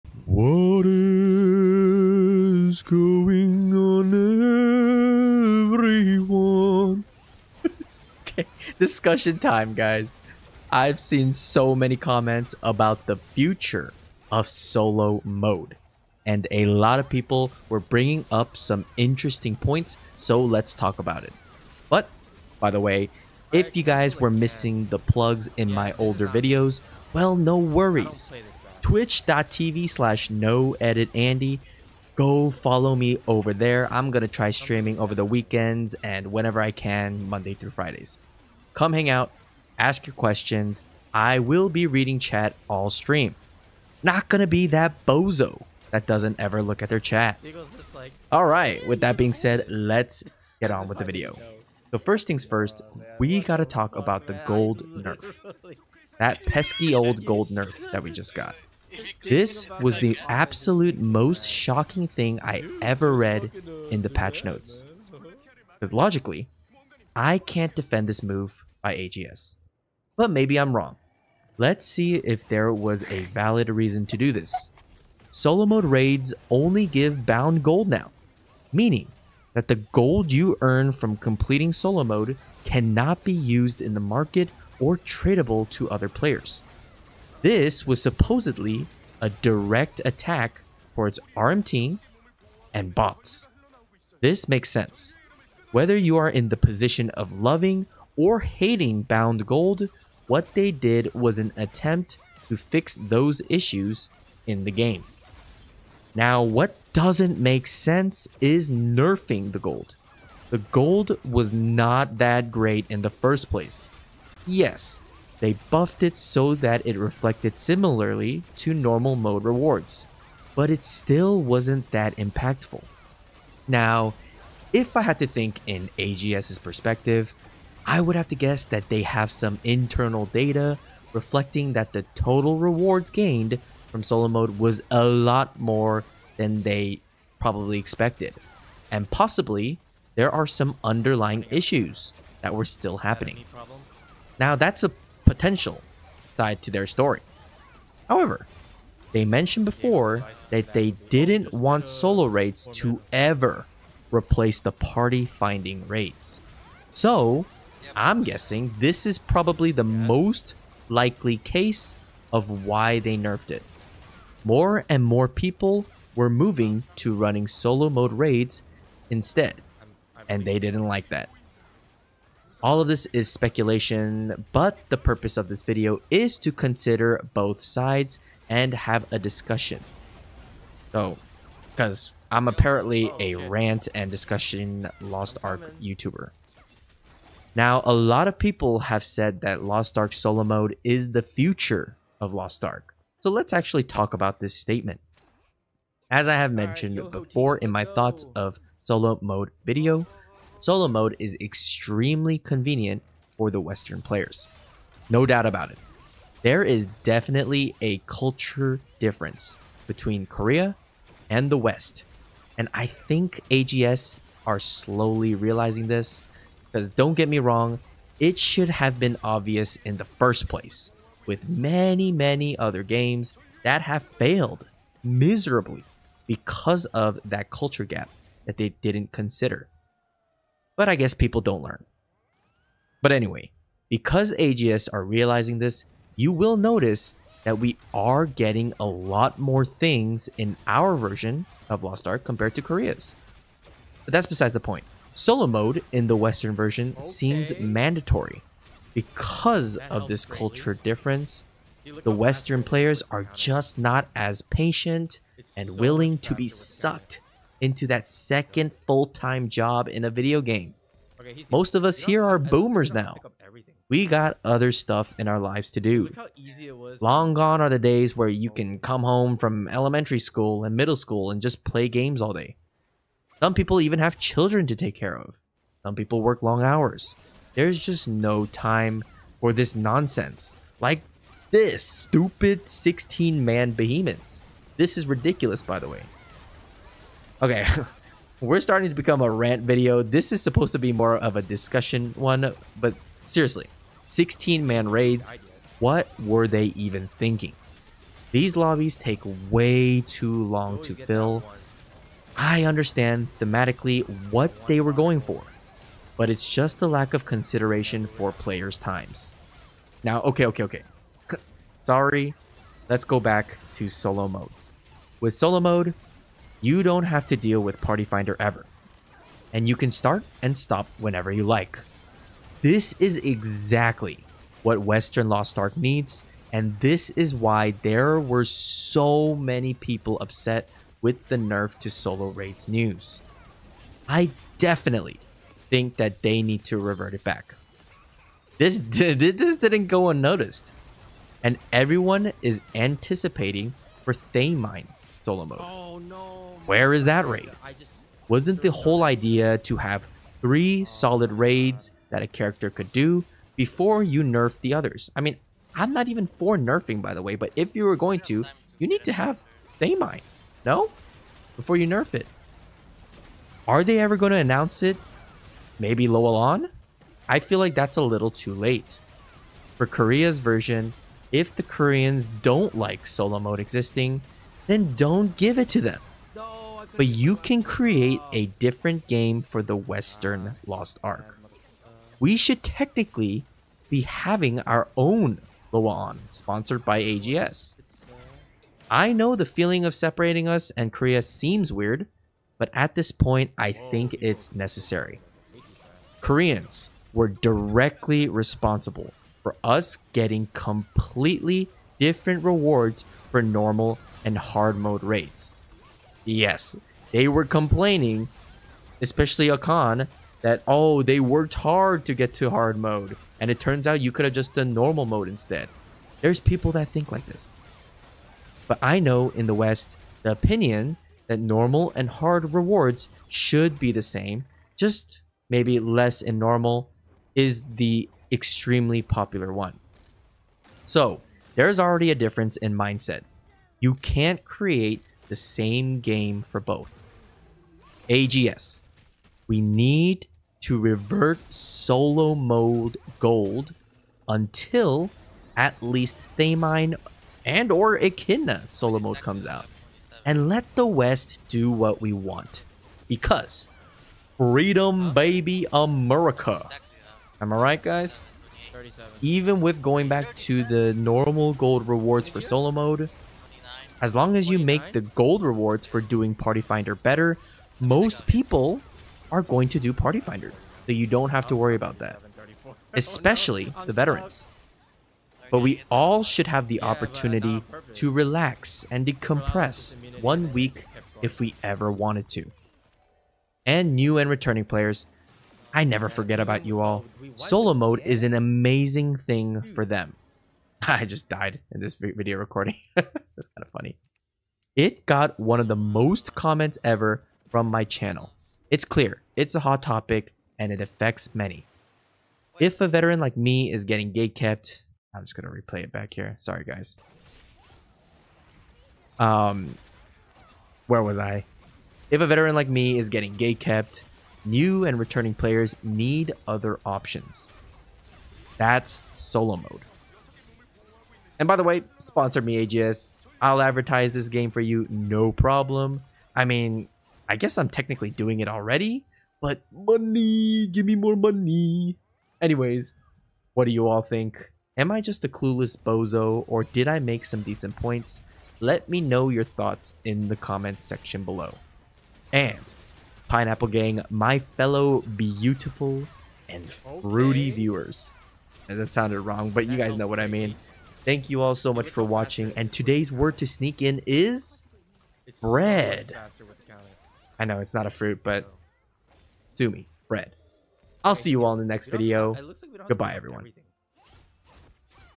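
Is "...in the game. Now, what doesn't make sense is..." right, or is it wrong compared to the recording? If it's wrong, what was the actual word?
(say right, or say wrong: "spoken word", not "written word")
right.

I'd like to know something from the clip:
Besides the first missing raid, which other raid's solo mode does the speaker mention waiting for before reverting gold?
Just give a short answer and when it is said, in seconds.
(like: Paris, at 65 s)
Echidna, at 447 s.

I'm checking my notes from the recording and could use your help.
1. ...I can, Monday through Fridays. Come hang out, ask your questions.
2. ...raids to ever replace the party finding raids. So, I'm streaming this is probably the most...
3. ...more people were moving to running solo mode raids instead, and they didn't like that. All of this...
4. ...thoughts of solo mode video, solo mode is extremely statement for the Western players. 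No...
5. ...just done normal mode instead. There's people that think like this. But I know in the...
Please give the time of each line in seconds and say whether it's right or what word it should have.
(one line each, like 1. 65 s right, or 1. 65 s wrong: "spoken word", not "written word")
1. 36 s right
2. 152 s wrong: "guessing", not "streaming"
3. 165 s right
4. 197 s wrong: "convenient", not "statement"
5. 414 s right.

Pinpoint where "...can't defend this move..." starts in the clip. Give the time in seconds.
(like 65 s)
67 s.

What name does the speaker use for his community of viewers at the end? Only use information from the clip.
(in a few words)
Pineapple Gang.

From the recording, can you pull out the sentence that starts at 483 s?
And new and returning players, I never forget about you all.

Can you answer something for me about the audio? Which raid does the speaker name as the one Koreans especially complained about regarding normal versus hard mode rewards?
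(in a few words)
Akkan.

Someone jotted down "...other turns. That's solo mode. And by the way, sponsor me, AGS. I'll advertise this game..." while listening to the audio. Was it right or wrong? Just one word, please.
wrong.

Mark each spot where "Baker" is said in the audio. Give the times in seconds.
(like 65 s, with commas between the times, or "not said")
not said.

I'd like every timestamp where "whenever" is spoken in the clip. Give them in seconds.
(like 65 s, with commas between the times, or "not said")
36 s, 320 s.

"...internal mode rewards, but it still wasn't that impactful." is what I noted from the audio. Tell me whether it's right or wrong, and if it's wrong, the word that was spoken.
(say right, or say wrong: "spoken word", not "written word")
wrong: "normal", not "internal".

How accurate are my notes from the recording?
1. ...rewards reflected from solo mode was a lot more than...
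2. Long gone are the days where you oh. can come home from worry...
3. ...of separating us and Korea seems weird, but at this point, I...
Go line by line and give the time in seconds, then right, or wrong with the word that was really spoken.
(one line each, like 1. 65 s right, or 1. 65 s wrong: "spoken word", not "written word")
1. 132 s wrong: "gained", not "reflected"
2. 267 s wrong: "elementary", not "worry"
3. 389 s right.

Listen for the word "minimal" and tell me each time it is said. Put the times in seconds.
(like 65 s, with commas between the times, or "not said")
not said.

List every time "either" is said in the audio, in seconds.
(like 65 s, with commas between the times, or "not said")
not said.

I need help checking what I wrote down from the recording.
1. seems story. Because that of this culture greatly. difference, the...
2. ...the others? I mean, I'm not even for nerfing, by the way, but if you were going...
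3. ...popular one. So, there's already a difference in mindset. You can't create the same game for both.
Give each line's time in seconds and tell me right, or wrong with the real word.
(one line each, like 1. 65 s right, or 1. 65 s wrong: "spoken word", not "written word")
1. 247 s wrong: "mandatory", not "story"
2. 354 s right
3. 429 s right.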